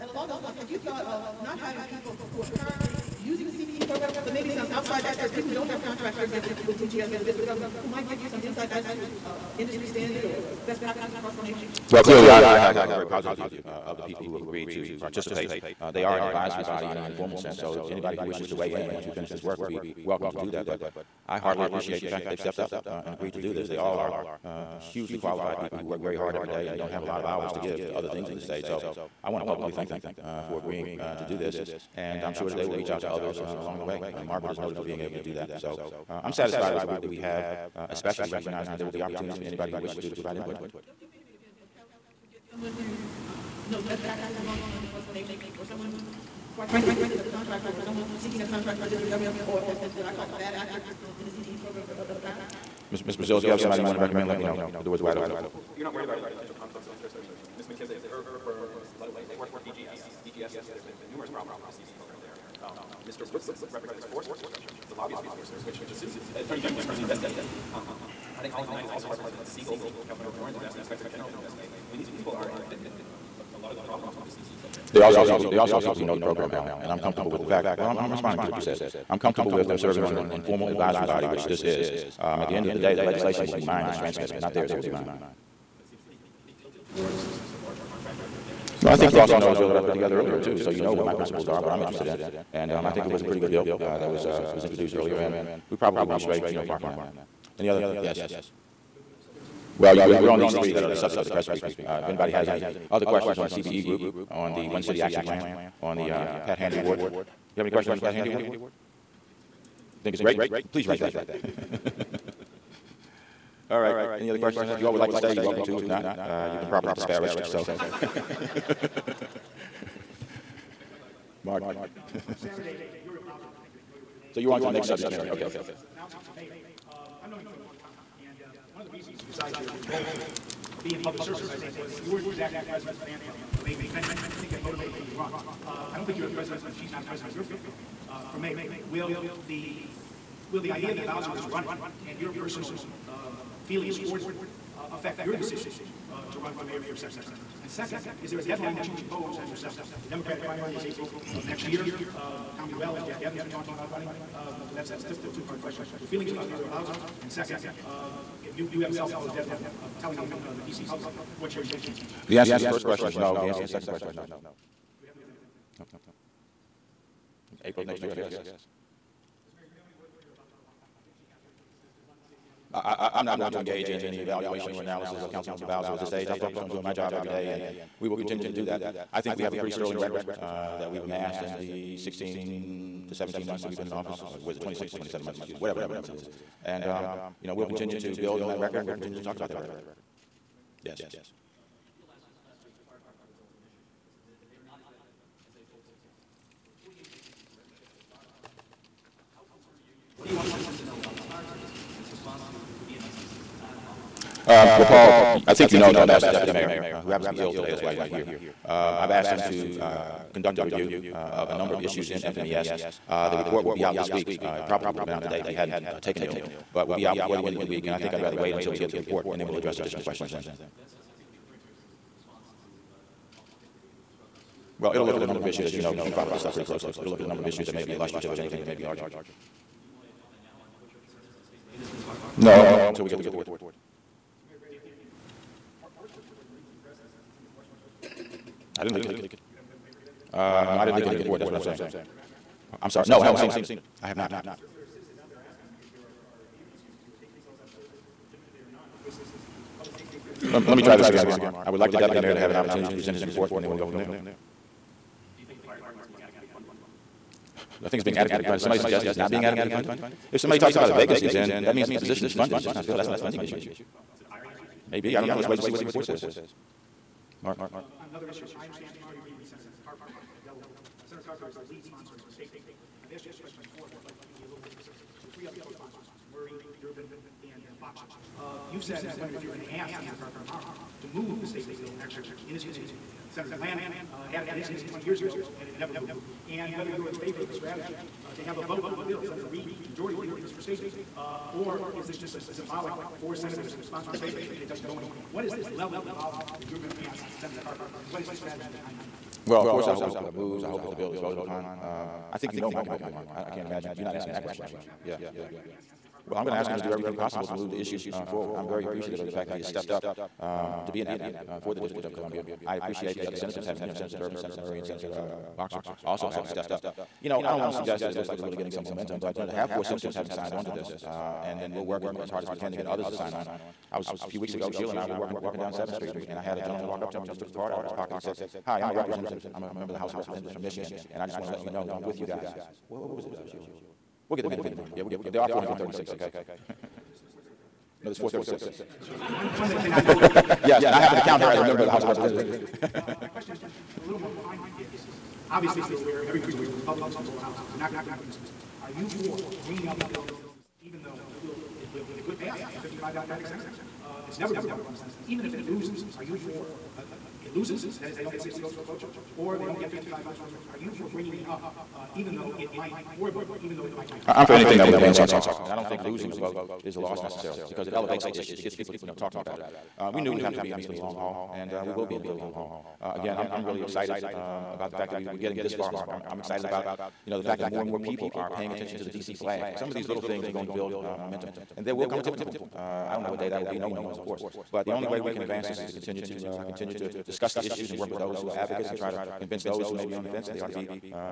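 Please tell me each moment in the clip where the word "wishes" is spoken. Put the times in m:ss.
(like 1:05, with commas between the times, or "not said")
0:18, 0:39.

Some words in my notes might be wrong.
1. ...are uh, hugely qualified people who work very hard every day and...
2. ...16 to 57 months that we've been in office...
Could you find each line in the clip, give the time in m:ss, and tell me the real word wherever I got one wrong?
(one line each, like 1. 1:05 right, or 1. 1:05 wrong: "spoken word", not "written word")
1. 0:23 right
2. 3:01 wrong: "17", not "57".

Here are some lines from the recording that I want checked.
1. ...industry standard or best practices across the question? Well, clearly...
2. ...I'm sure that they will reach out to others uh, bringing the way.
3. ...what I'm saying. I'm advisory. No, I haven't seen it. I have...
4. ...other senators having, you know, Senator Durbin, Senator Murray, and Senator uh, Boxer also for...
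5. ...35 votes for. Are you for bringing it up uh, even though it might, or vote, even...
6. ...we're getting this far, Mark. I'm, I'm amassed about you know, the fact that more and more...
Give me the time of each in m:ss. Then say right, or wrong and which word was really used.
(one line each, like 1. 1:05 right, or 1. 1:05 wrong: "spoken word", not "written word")
1. 0:09 wrong: "nation", not "question"
2. 0:32 wrong: "along", not "bringing"
3. 4:01 wrong: "sorry", not "advisory"
4. 5:13 right
5. 5:59 wrong: "55", not "35"
6. 6:15 wrong: "excited", not "amassed".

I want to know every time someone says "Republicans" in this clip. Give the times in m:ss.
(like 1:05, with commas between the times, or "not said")
5:46.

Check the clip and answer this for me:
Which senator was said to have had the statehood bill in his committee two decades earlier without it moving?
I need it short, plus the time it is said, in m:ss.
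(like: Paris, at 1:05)
Senator Glenn, at 4:43.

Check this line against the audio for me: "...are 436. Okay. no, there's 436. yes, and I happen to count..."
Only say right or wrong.
right.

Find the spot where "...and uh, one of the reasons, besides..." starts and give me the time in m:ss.
2:08.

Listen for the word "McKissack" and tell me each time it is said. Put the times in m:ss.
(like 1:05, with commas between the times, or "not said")
0:57.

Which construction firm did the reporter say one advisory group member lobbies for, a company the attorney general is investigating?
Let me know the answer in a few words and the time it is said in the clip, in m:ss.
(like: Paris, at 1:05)
Forrester Construction, at 1:04.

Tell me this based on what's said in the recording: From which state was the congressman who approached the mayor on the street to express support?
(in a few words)
Michigan.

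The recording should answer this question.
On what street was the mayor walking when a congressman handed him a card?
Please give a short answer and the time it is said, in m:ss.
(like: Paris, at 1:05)
Seventh Street, at 5:25.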